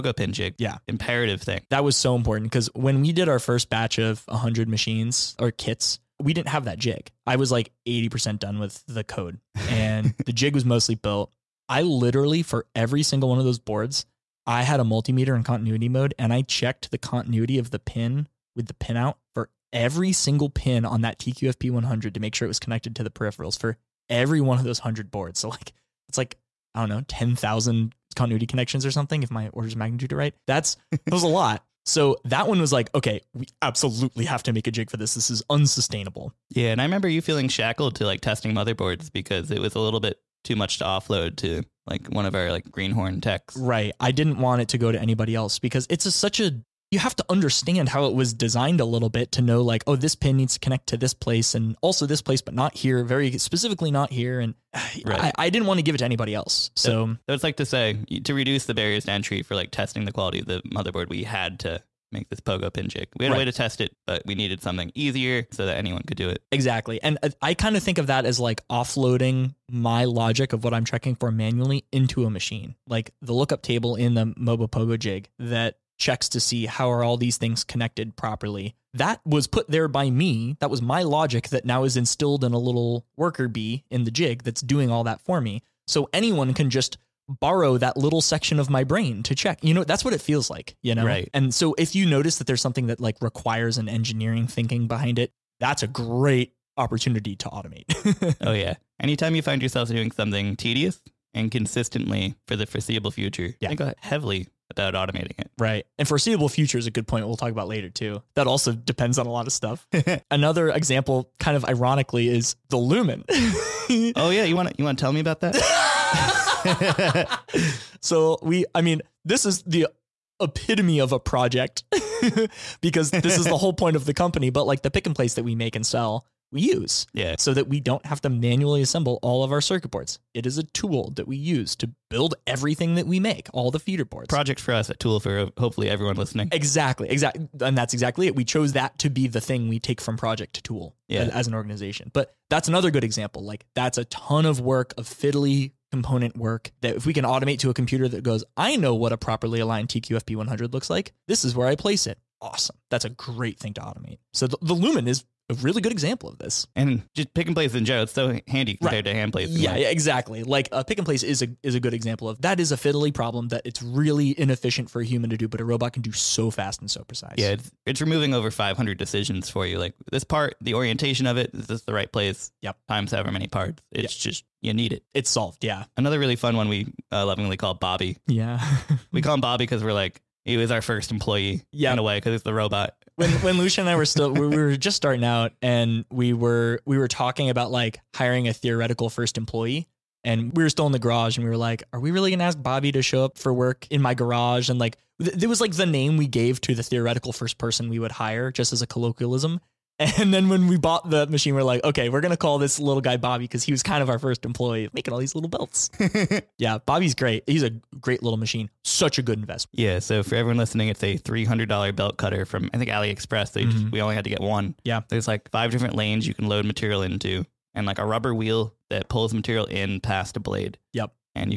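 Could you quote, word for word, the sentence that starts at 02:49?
Like this part, the orientation of it, is this the right place?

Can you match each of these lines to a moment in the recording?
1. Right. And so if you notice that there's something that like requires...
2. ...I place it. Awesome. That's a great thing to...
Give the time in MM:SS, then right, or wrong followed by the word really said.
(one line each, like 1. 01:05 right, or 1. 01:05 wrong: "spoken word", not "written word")
1. 01:31 right
2. 02:31 right.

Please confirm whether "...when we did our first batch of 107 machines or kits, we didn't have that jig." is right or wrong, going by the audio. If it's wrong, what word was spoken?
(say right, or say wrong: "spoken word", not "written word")
wrong: "100", not "107".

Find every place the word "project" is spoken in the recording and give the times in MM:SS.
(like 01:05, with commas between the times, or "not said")
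02:01, 02:14, 02:20.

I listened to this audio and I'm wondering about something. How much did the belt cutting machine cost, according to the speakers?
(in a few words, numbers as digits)
$300.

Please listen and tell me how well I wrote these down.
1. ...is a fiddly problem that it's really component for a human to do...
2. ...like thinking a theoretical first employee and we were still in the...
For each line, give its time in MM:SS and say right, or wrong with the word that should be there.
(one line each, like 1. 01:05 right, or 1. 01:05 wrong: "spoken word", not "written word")
1. 02:42 wrong: "inefficient", not "component"
2. 03:07 wrong: "hiring", not "thinking".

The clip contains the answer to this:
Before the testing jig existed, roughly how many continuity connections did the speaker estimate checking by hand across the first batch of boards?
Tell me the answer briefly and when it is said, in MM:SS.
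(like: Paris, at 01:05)
10,000, at 00:27.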